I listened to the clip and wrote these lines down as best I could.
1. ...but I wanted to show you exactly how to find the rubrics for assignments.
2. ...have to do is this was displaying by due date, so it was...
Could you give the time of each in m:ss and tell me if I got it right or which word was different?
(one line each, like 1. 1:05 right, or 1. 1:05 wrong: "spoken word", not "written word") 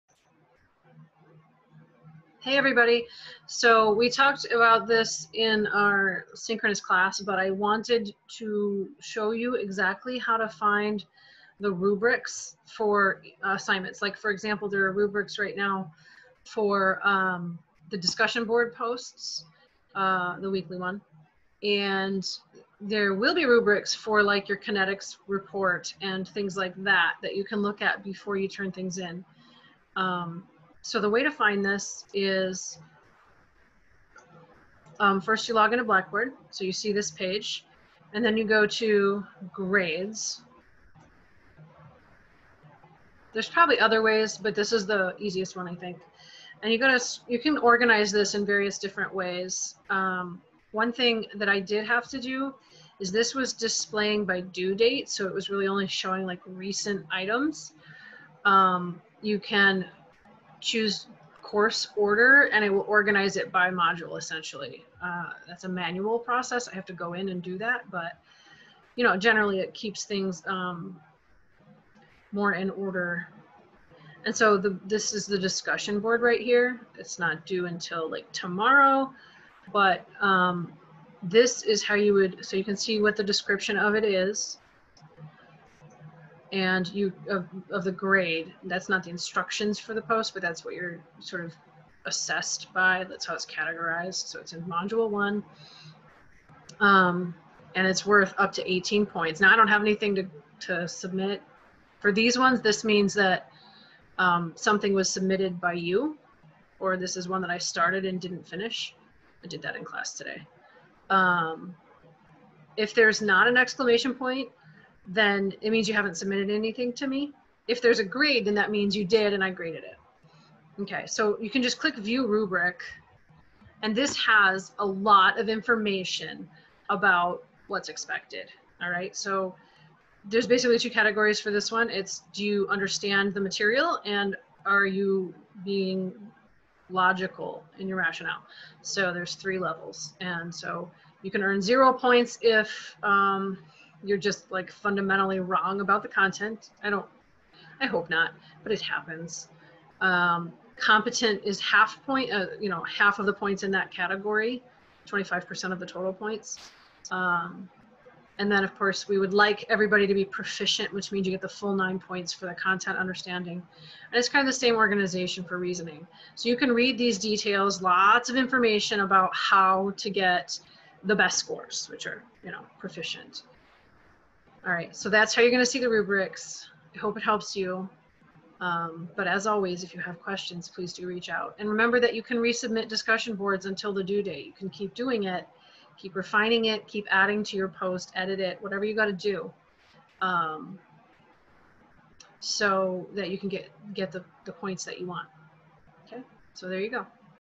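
1. 0:07 right
2. 0:51 right.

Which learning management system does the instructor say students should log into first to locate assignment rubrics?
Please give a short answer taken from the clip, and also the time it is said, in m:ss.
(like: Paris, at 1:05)
Blackboard, at 0:35.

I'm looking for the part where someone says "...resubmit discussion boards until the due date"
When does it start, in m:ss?
3:02.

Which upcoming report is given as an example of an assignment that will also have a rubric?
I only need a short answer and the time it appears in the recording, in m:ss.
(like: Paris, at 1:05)
kinetics report, at 0:24.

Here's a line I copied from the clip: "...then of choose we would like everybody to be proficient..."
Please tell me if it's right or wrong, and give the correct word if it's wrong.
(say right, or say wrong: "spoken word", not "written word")
wrong: "course", not "choose".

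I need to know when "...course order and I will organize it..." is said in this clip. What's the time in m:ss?
1:01.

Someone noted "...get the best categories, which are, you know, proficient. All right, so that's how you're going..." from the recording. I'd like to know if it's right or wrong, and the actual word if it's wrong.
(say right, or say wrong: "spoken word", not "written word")
wrong: "scores", not "categories".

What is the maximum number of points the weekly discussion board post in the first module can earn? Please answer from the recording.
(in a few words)
18.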